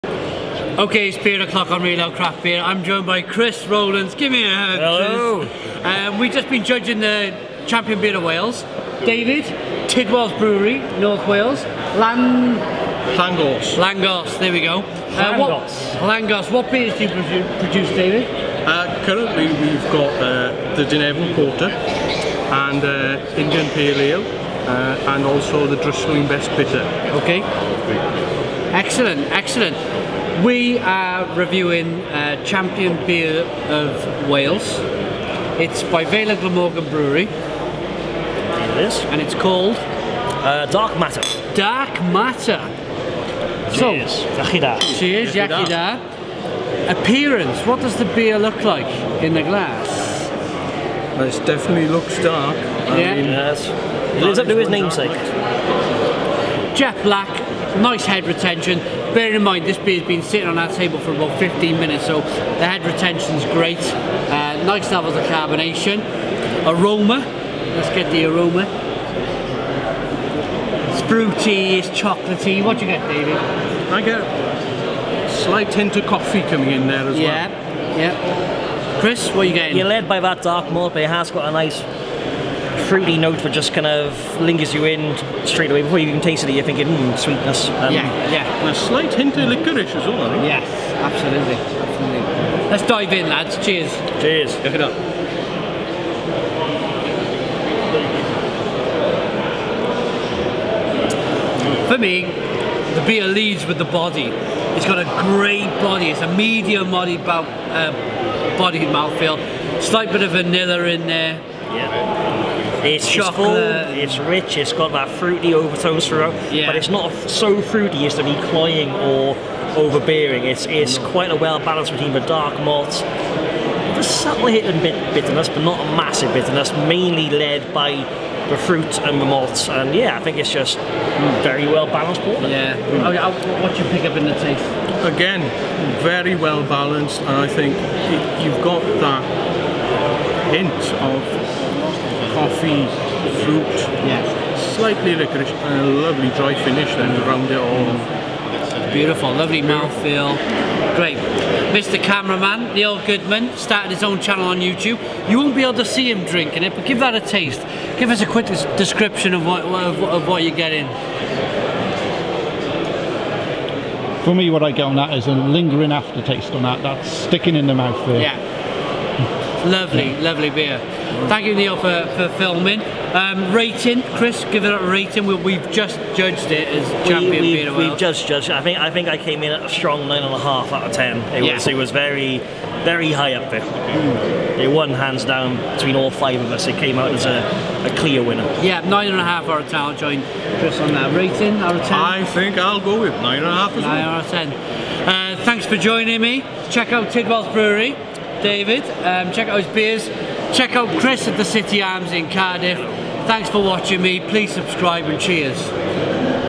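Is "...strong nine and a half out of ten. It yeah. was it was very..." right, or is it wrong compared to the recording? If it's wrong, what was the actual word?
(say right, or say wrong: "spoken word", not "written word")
right.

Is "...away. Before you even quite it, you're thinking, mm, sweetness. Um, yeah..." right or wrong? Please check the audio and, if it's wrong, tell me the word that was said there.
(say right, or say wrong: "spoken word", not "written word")
wrong: "taste", not "quite".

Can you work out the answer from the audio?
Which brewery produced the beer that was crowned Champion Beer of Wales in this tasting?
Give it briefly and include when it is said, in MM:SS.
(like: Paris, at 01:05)
Vale of Glamorgan Brewery, at 00:36.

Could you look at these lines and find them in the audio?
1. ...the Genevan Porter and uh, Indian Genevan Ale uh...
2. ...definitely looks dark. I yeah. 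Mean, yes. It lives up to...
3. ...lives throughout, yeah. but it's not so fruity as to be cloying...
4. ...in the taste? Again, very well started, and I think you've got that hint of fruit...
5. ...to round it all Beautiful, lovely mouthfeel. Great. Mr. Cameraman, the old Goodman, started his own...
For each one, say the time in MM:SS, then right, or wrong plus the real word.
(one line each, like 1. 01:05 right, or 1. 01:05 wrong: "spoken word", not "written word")
1. 00:20 wrong: "Pale", not "Genevan"
2. 00:51 right
3. 01:55 wrong: "overtones", not "lives"
4. 02:14 wrong: "balanced", not "started"
5. 02:27 right.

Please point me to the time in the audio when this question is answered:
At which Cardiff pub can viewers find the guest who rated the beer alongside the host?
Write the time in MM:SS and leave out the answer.
03:21.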